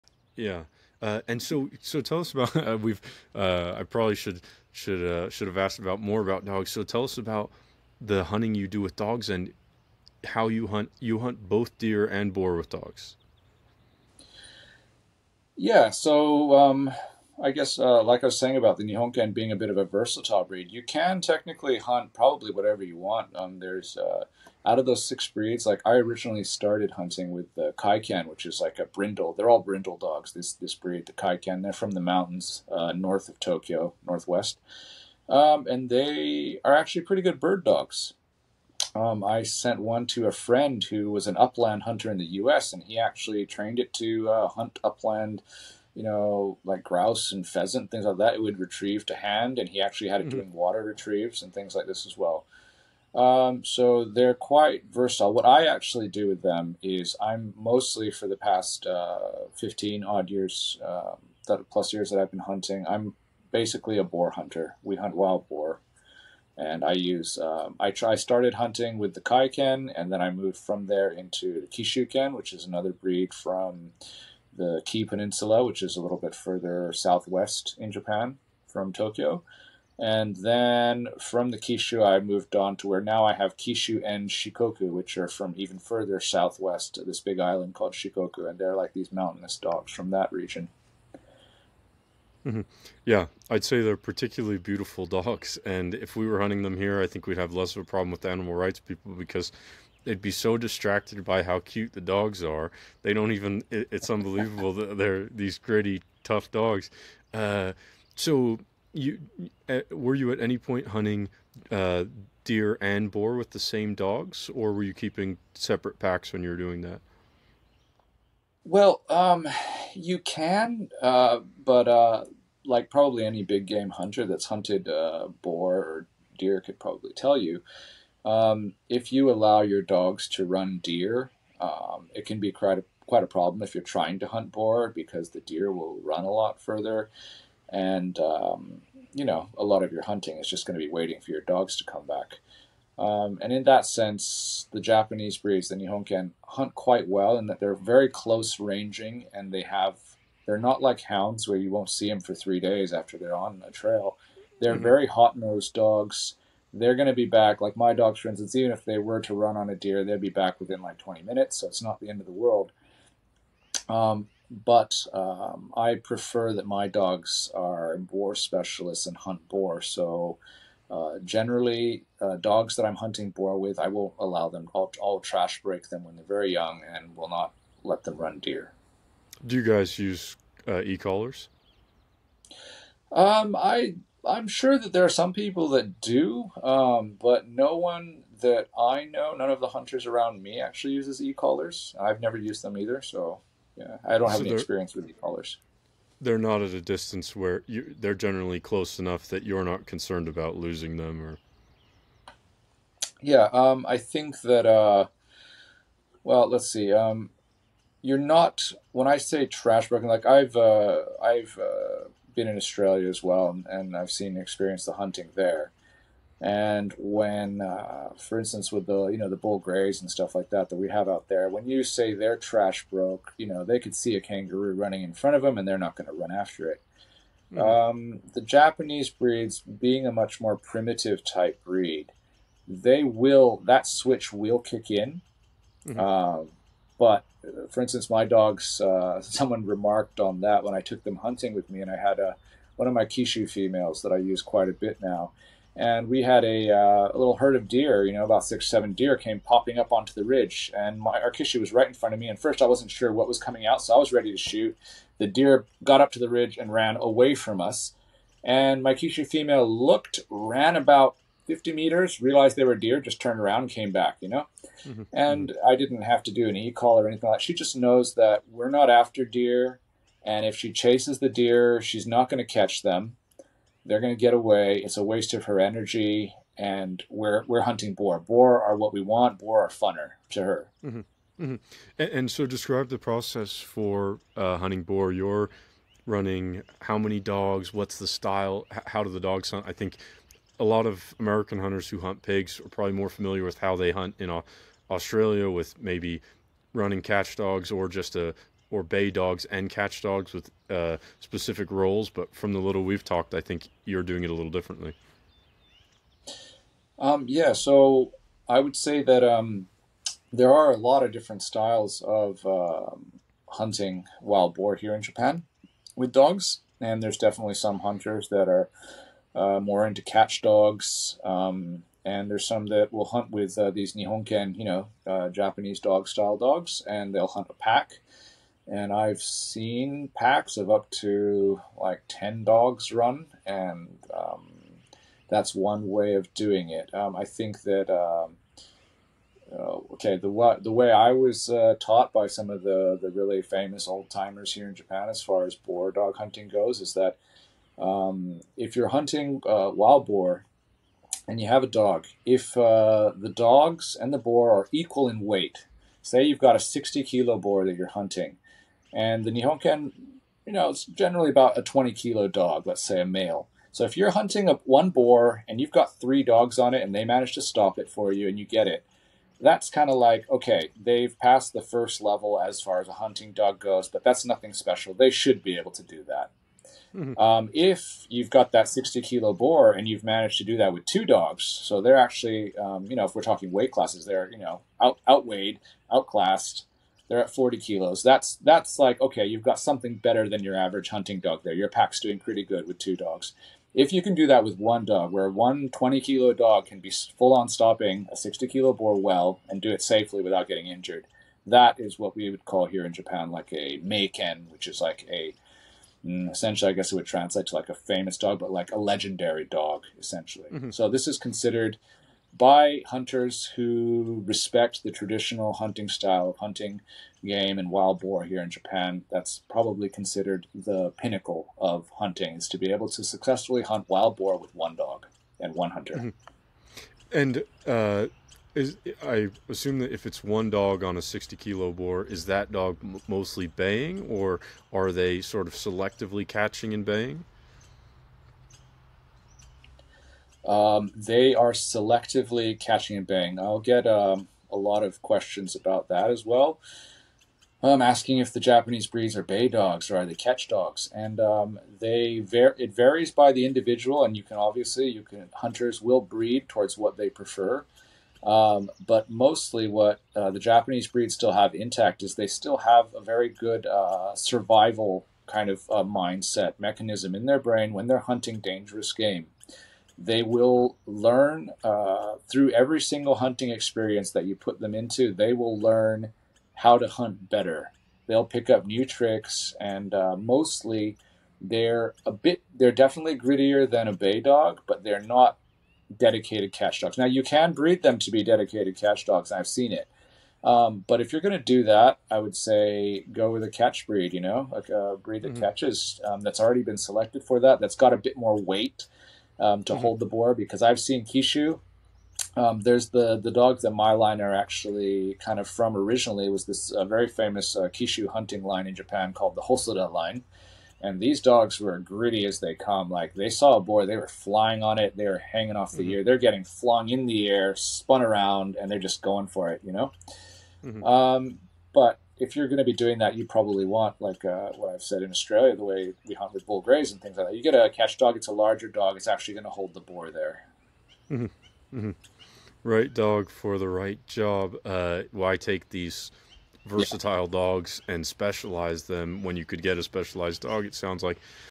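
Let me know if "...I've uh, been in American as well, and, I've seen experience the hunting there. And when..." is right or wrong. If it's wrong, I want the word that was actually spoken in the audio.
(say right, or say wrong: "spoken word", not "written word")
wrong: "Australia", not "American".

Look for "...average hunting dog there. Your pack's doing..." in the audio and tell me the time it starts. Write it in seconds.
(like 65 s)
390 s.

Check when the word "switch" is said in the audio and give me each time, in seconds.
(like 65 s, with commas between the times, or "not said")
233 s.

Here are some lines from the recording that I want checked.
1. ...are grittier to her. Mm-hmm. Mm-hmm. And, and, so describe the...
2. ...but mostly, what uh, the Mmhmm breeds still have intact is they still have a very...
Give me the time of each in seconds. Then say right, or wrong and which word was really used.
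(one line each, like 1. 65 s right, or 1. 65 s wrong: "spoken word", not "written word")
1. 279 s wrong: "funner", not "grittier"
2. 458 s wrong: "Japanese", not "Mmhmm".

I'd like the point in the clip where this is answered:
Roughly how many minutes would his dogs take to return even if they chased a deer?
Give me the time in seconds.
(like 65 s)
160 s.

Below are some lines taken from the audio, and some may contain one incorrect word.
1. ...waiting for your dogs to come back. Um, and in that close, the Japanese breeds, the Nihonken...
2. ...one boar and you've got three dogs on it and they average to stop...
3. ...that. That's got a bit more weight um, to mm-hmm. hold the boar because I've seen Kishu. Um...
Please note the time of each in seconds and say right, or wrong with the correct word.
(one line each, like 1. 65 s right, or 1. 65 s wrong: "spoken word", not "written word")
1. 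140 s wrong: "sense", not "close"
2. 364 s wrong: "manage", not "average"
3. 497 s right.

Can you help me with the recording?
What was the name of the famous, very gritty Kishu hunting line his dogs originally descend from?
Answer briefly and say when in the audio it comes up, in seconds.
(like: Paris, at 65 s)
Hosoda line, at 509 s.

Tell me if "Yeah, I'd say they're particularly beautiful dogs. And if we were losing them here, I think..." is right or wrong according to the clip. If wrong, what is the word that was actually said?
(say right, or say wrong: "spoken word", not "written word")
wrong: "hunting", not "losing".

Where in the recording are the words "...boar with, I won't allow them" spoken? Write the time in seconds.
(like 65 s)
173 s.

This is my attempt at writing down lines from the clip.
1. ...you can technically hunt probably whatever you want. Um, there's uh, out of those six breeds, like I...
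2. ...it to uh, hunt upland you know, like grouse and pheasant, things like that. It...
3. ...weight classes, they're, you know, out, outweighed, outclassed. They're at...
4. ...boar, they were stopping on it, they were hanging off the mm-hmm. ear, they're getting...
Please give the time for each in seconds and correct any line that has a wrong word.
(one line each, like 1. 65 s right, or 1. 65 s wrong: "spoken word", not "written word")
1. 20 s right
2. 43 s right
3. 383 s right
4. 513 s wrong: "flying", not "stopping".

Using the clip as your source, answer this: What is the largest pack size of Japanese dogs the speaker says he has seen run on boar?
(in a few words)
10.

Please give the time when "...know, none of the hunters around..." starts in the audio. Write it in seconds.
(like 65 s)
189 s.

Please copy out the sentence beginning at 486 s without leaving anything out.
Now you can breed them to be dedicated catch dogs.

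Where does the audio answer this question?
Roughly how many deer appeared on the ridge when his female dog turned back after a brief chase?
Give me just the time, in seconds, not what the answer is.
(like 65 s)
248 s.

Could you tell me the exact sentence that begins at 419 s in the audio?
That's probably considered the pinnacle of hunting is to be able to successfully hunt wild boar with one dog and one hunter.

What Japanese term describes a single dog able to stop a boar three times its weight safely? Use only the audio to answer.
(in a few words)
meiken.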